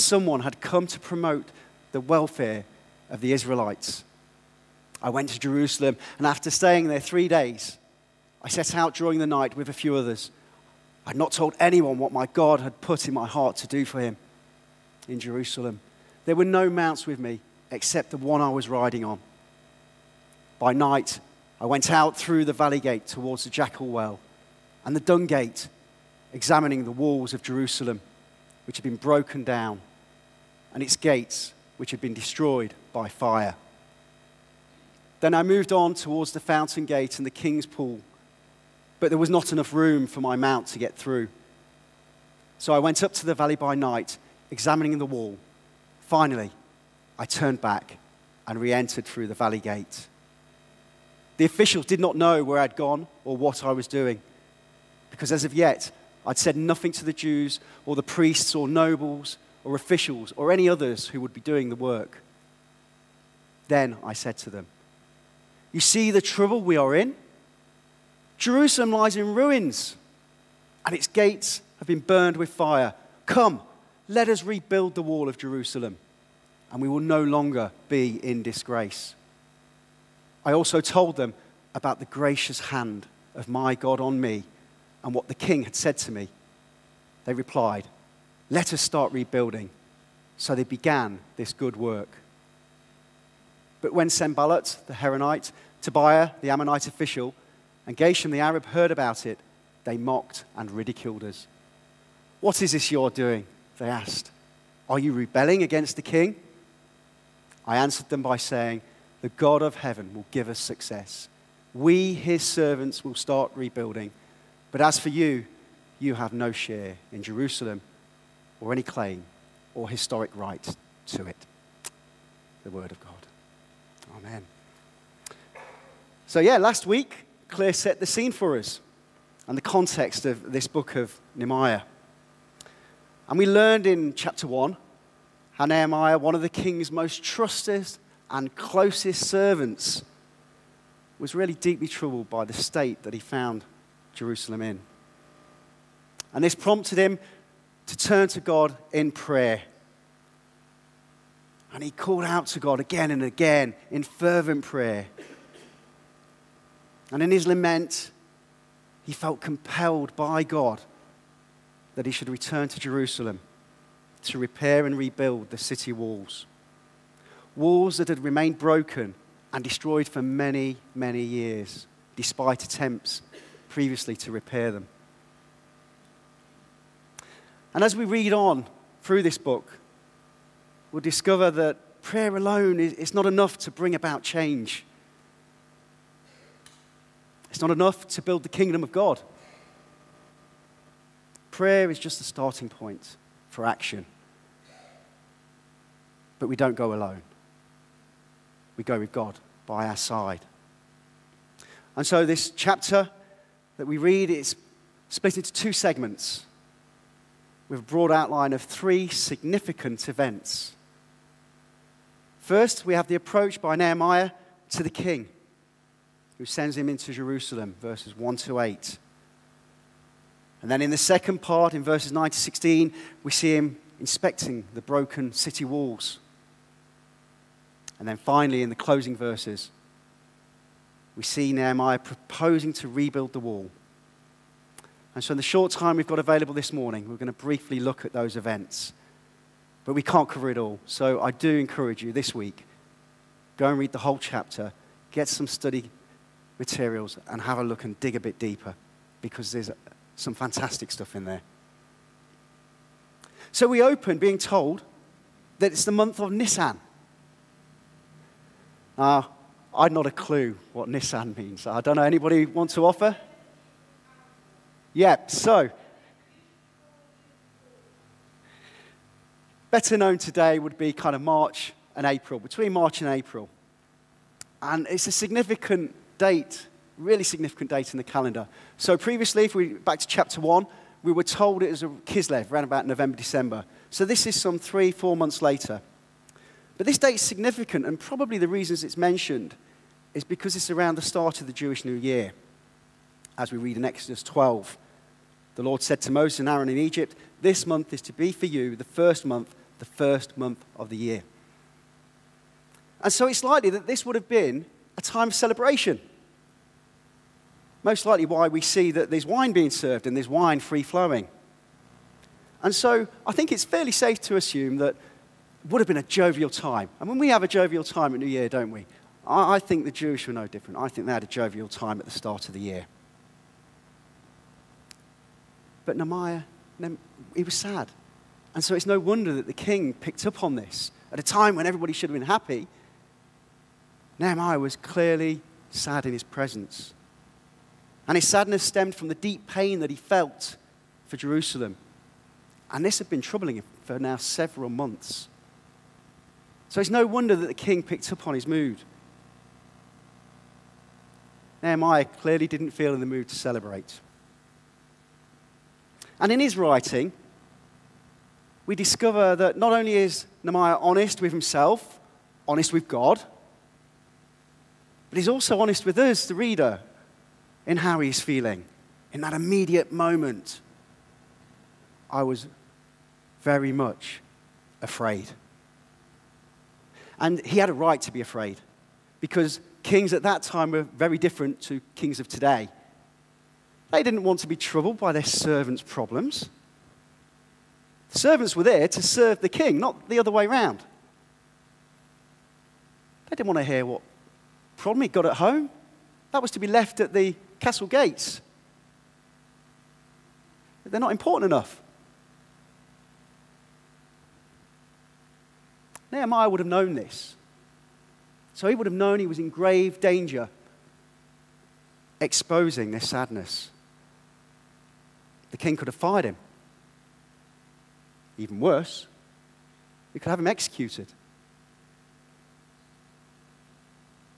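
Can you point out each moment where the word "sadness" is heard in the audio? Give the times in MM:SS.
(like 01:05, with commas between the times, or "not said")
05:38, 06:53.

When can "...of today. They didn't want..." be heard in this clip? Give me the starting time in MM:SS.
06:22.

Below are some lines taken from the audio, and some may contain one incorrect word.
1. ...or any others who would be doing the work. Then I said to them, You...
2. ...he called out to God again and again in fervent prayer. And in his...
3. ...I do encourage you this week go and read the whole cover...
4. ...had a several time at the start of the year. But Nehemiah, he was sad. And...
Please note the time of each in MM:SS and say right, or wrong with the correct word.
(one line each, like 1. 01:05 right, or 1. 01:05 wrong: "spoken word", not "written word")
1. 01:00 right
2. 02:31 right
3. 04:01 wrong: "chapter", not "cover"
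4. 05:21 wrong: "jovial", not "several".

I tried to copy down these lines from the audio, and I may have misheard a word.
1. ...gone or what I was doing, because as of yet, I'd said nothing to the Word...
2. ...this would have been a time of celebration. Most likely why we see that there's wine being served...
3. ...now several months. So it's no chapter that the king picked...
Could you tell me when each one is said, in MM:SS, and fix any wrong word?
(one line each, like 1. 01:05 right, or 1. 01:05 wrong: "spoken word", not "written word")
1. 00:52 wrong: "Jews", not "Word"
2. 05:03 right
3. 05:43 wrong: "wonder", not "chapter".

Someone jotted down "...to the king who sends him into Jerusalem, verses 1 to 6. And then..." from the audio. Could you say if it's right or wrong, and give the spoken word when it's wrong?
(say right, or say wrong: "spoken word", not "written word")
wrong: "8", not "6".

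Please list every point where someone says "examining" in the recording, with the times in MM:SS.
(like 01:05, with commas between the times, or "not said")
00:26, 00:44.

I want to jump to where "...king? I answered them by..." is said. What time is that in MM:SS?
01:46.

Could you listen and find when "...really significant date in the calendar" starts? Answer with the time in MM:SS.
04:36.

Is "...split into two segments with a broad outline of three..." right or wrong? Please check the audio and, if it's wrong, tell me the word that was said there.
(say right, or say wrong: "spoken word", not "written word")
right.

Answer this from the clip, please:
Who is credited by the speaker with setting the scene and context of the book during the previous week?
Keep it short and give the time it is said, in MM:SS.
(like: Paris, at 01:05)
Claire, at 02:07.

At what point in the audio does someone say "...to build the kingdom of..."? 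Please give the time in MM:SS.
03:08.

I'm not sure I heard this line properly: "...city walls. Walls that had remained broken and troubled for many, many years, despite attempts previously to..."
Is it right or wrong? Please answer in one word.
wrong.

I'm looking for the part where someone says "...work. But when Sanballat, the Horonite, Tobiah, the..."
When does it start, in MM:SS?
01:31.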